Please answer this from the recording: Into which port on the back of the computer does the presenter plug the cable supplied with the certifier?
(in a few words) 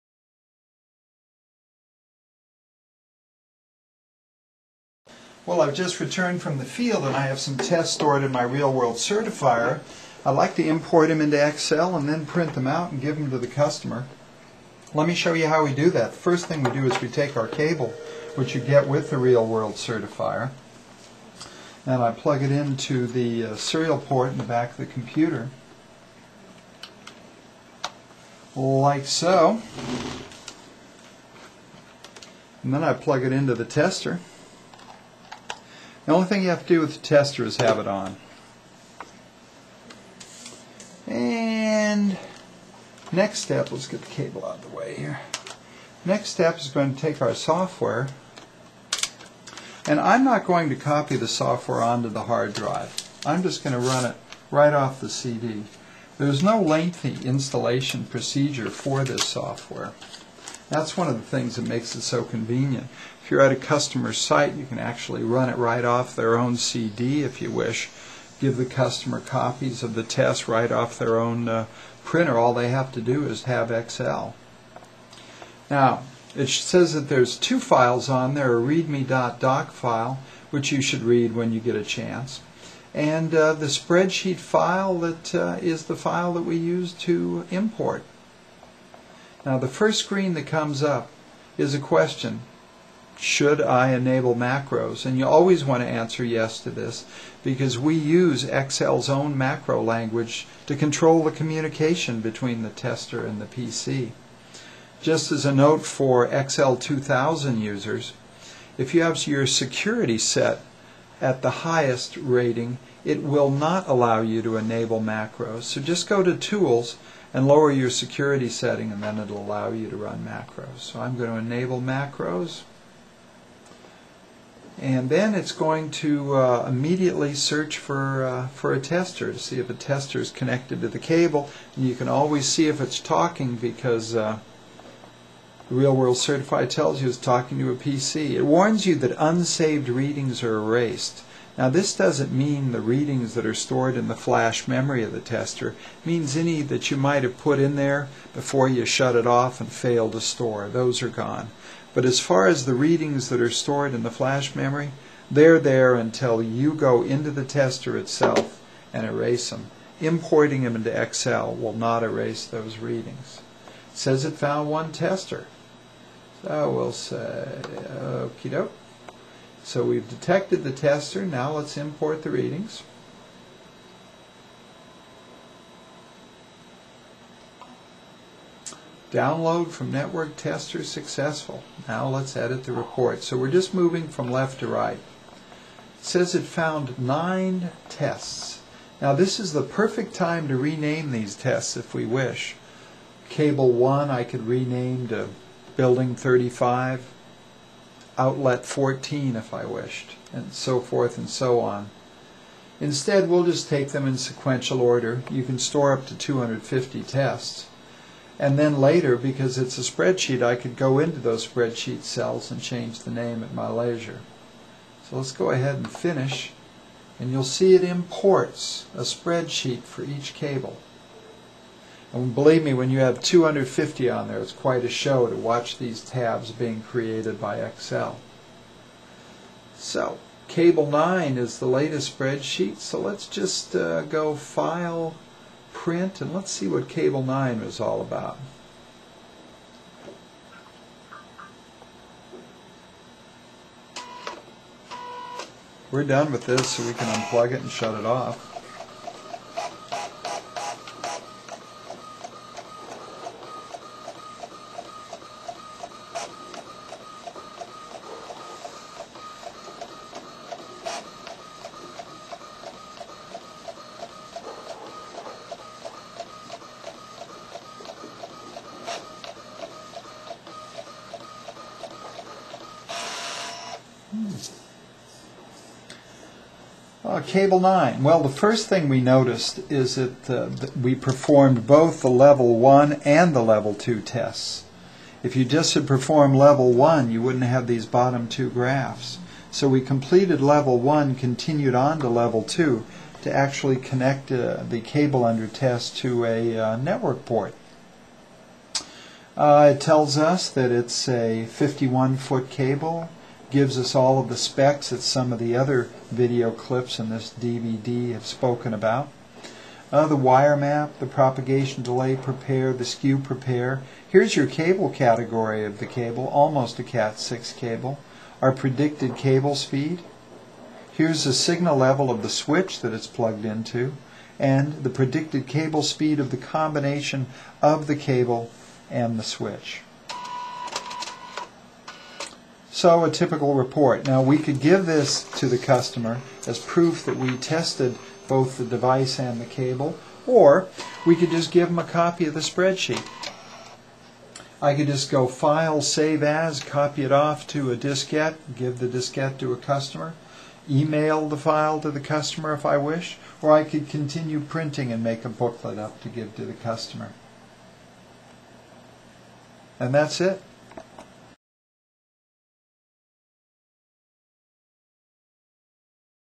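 Serial port.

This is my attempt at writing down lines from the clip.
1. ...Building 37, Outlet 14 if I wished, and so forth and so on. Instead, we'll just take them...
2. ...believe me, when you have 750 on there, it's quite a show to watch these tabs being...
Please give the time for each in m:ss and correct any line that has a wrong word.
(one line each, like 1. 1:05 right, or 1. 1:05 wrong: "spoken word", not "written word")
1. 3:15 wrong: "35", not "37"
2. 3:42 wrong: "250", not "750".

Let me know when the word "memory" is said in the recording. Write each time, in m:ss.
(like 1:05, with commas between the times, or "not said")
2:24, 2:34.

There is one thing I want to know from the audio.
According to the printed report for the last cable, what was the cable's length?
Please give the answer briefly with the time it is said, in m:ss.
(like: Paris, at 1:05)
51 feet, at 5:01.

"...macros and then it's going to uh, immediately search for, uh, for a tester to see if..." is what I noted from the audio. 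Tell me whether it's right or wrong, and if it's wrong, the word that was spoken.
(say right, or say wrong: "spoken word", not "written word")
right.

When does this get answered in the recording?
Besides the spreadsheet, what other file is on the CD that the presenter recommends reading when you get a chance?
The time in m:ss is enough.
1:18.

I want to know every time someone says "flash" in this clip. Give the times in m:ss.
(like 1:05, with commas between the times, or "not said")
2:24, 2:34.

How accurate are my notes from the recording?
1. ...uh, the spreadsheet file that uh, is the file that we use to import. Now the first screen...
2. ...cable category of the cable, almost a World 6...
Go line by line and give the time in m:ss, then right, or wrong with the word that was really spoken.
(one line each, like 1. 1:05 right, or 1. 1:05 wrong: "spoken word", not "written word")
1. 1:23 right
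2. 5:14 wrong: "Cat", not "World".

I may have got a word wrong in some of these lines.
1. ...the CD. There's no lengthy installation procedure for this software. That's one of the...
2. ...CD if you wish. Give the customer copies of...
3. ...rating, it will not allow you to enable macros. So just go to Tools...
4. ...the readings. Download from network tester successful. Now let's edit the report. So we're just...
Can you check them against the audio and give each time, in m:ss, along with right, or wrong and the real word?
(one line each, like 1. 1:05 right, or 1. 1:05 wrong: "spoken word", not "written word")
1. 0:55 right
2. 1:06 right
3. 1:52 right
4. 2:52 right.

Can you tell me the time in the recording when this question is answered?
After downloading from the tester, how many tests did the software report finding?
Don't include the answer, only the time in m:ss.
3:06.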